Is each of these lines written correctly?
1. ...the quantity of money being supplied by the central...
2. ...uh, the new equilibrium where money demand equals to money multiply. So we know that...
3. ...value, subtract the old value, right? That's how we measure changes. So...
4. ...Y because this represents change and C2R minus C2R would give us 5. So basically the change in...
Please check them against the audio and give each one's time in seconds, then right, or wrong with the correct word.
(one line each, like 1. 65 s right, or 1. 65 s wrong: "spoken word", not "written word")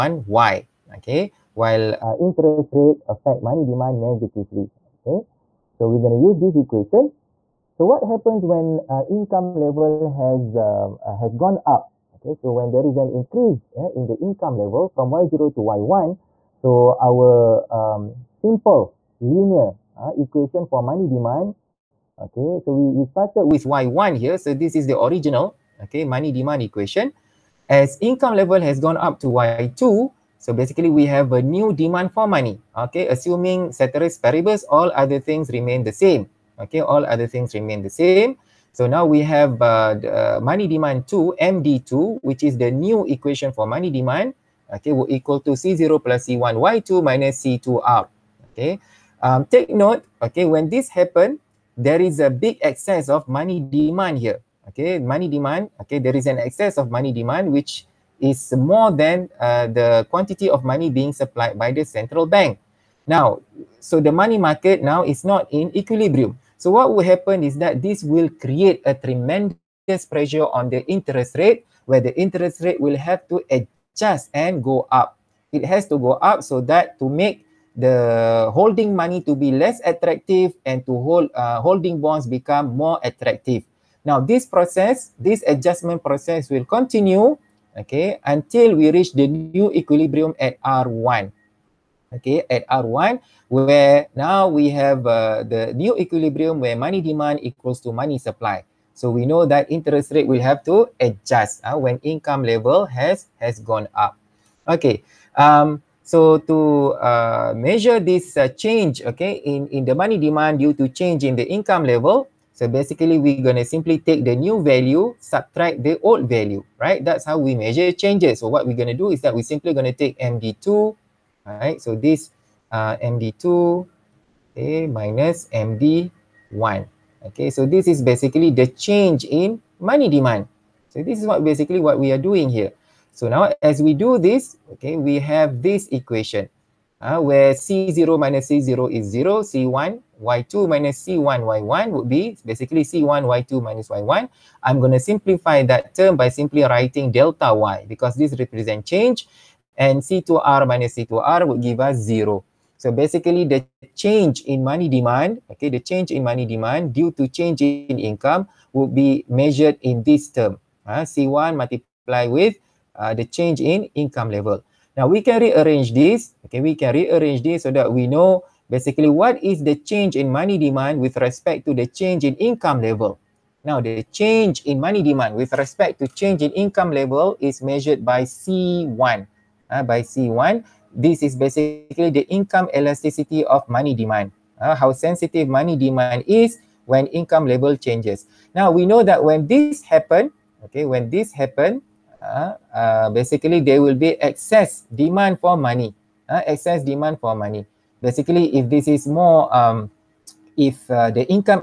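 1. 59 s right
2. 95 s wrong: "supply", not "multiply"
3. 114 s right
4. 147 s wrong: "0", not "5".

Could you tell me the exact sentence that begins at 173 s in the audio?
Now the change in money demand with respect to change in income level is measured by C1.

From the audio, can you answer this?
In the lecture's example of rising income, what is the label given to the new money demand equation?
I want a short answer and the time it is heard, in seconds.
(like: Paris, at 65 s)
MD2, at 40 s.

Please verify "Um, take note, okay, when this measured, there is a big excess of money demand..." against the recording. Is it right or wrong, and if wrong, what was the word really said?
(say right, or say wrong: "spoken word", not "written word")
wrong: "happened", not "measured".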